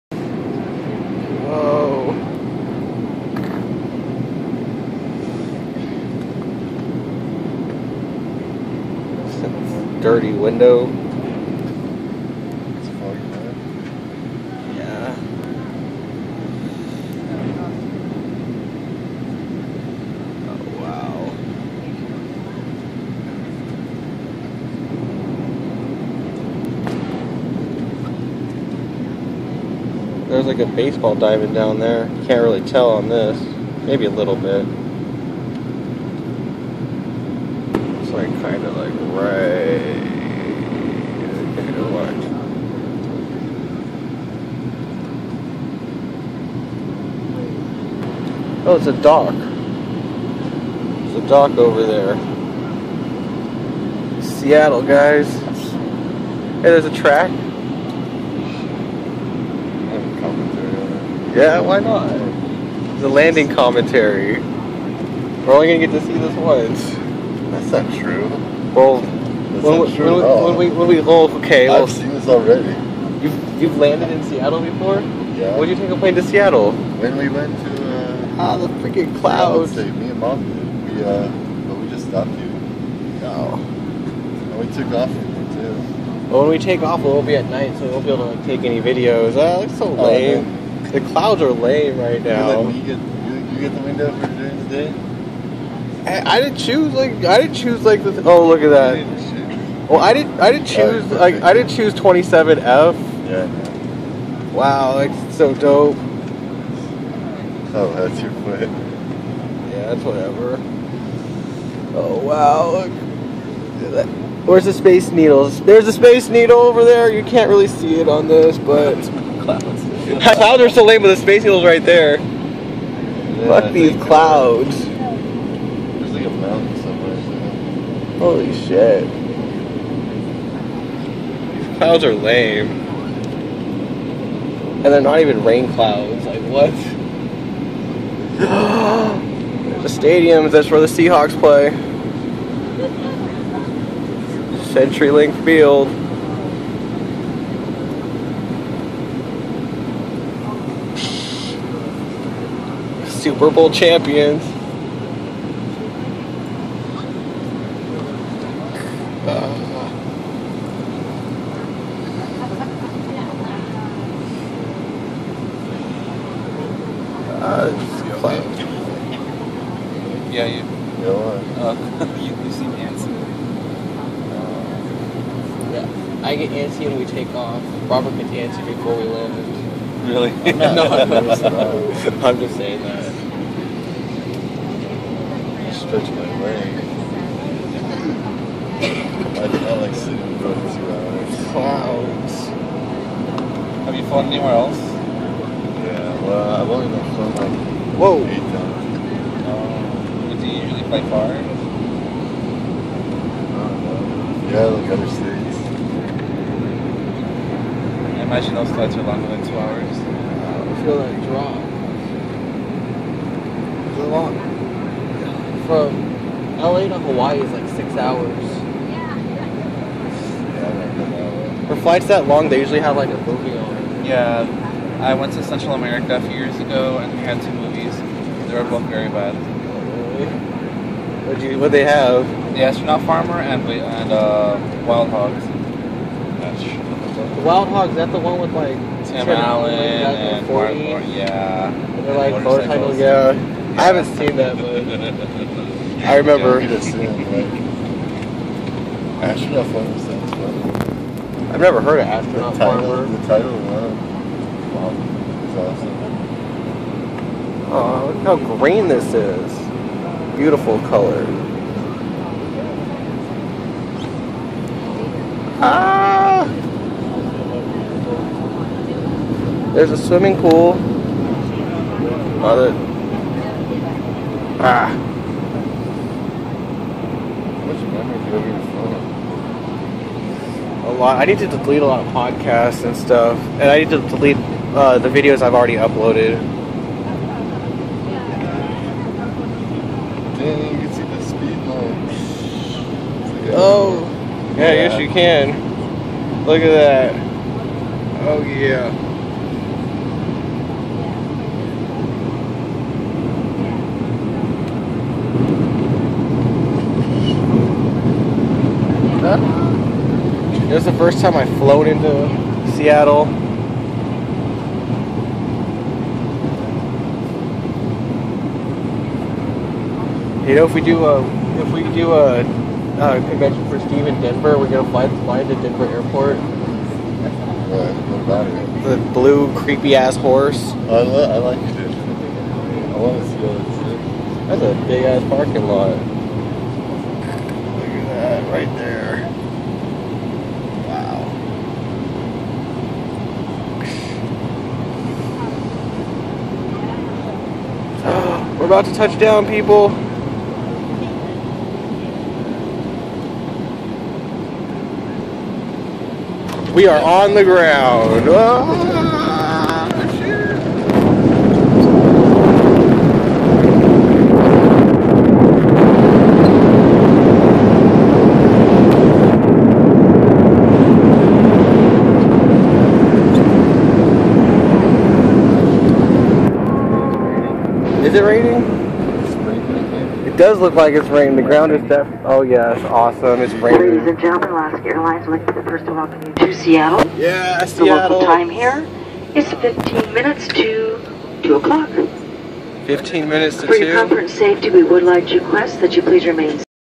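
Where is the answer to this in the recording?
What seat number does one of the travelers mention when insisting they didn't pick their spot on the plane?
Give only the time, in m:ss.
1:41.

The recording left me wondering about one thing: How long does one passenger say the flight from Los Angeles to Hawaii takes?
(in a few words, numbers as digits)
6 hours.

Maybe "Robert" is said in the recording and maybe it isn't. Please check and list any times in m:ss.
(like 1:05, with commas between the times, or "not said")
2:57.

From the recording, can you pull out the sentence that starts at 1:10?
when we when we well, okay, well, I've seen this already.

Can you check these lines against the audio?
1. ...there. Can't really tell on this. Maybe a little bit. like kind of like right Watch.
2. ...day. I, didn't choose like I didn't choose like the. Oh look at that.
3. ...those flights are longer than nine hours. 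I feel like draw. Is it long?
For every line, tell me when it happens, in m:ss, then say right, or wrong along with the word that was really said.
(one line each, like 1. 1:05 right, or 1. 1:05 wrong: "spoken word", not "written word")
1. 0:31 right
2. 1:34 right
3. 3:28 wrong: "two", not "nine".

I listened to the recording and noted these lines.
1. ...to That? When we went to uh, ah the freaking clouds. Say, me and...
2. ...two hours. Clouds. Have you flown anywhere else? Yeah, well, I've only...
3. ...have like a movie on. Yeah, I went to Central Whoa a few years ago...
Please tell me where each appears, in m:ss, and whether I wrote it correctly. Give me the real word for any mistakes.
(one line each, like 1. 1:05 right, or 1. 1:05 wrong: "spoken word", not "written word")
1. 1:16 wrong: "Seattle", not "That"
2. 3:10 right
3. 3:42 wrong: "America", not "Whoa".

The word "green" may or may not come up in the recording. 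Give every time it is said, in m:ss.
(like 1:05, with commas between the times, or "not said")
4:18.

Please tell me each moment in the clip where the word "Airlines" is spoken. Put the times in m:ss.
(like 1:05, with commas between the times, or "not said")
6:24.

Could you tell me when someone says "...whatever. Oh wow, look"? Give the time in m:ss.
1:50.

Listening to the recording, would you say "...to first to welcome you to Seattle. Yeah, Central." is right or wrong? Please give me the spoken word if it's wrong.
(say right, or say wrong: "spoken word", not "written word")
wrong: "Seattle", not "Central".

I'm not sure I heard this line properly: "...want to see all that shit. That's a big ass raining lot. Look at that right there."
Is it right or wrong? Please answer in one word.
wrong.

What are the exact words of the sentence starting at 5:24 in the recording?
We're gonna fly fly to Denver Airport.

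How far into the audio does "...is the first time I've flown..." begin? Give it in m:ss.
5:10.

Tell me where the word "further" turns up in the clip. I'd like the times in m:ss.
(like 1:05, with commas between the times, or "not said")
not said.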